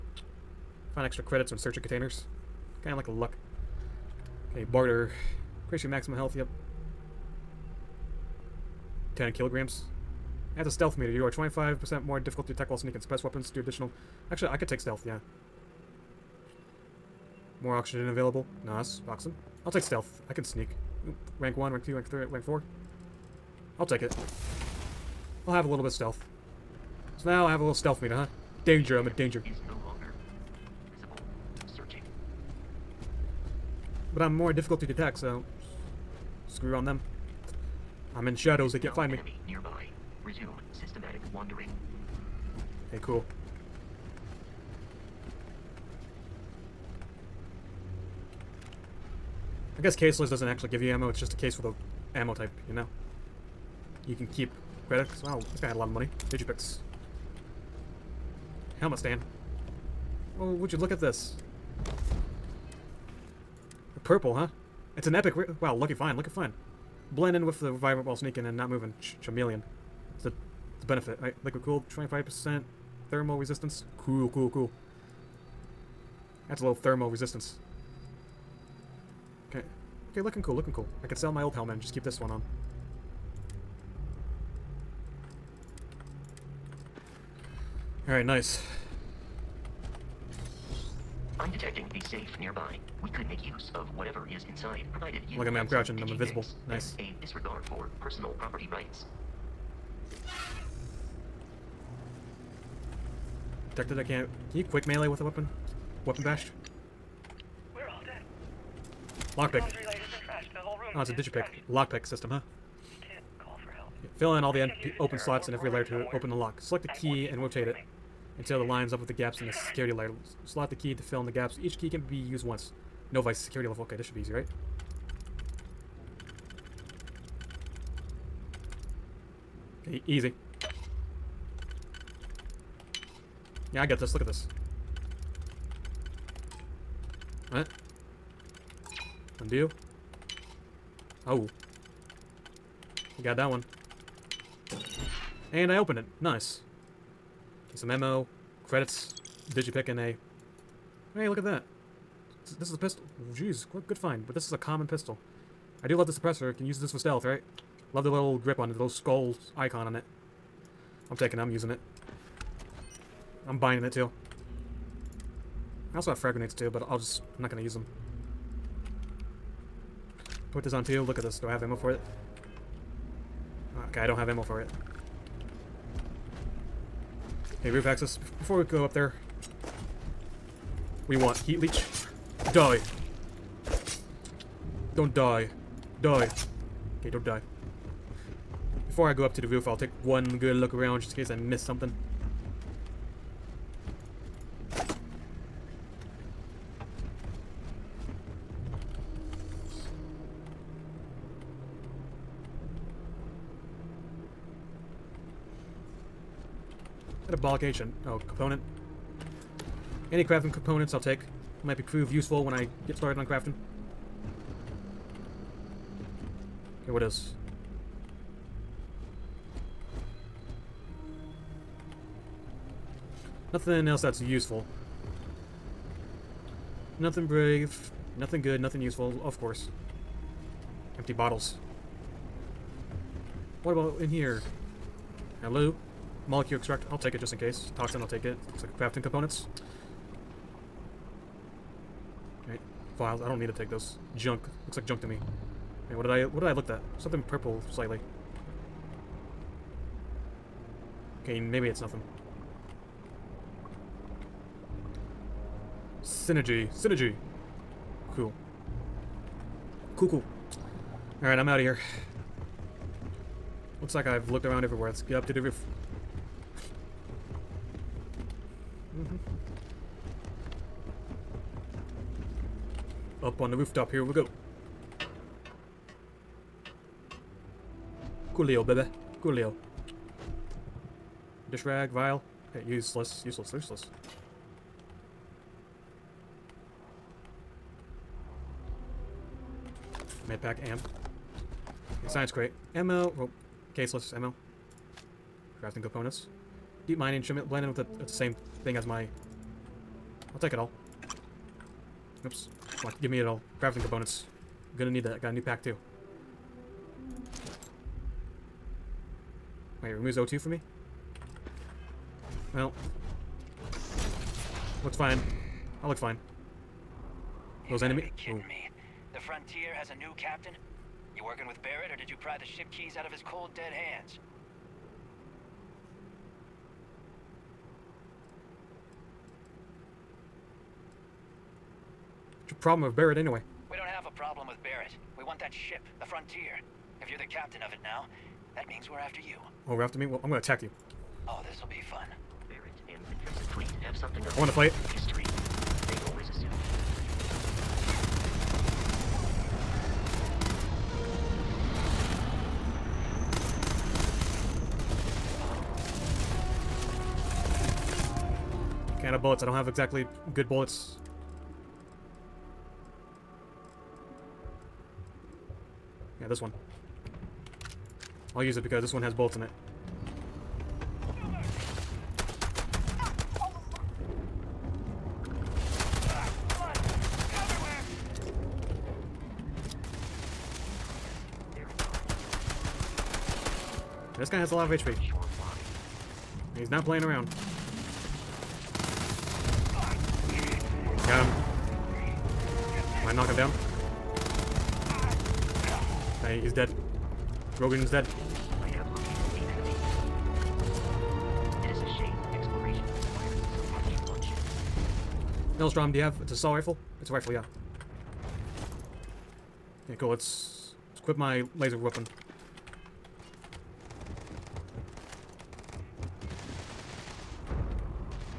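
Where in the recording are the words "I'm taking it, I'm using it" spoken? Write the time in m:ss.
2:41.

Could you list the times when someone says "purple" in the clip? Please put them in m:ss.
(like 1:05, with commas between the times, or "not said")
1:04, 4:07.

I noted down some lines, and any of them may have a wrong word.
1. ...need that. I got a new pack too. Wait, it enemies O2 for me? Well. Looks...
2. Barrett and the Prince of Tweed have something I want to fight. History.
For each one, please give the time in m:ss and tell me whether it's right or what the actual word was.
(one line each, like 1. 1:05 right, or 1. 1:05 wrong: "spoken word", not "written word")
1. 5:04 wrong: "removes", not "enemies"
2. 5:42 right.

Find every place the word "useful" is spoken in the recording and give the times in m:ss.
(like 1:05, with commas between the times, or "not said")
3:32, 3:44, 3:48.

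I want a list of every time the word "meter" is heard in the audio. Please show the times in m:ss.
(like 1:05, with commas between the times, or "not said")
0:10, 0:27.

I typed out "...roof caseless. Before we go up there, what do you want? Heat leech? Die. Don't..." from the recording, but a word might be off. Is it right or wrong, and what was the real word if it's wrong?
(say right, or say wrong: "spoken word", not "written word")
wrong: "access", not "caseless".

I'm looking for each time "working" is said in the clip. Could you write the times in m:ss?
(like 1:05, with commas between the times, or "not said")
5:21.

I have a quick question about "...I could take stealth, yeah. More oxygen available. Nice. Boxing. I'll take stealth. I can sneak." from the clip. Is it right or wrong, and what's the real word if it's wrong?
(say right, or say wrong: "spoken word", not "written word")
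right.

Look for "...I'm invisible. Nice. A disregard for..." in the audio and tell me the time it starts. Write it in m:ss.
1:36.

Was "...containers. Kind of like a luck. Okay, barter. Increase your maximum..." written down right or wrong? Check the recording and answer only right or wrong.
right.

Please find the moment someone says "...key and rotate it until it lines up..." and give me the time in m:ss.
1:56.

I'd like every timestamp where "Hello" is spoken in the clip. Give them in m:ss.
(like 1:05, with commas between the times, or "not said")
3:55.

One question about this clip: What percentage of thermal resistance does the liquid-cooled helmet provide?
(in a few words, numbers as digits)
25%.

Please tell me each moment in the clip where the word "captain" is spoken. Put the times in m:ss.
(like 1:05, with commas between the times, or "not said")
5:20, 5:37.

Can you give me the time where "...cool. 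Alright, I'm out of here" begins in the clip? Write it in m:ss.
4:20.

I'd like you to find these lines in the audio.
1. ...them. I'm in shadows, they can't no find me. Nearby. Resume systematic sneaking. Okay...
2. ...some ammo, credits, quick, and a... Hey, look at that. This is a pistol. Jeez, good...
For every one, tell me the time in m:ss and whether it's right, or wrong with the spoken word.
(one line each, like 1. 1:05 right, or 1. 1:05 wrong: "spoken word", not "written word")
1. 0:36 wrong: "wandering", not "sneaking"
2. 2:27 wrong: "digipick", not "quick".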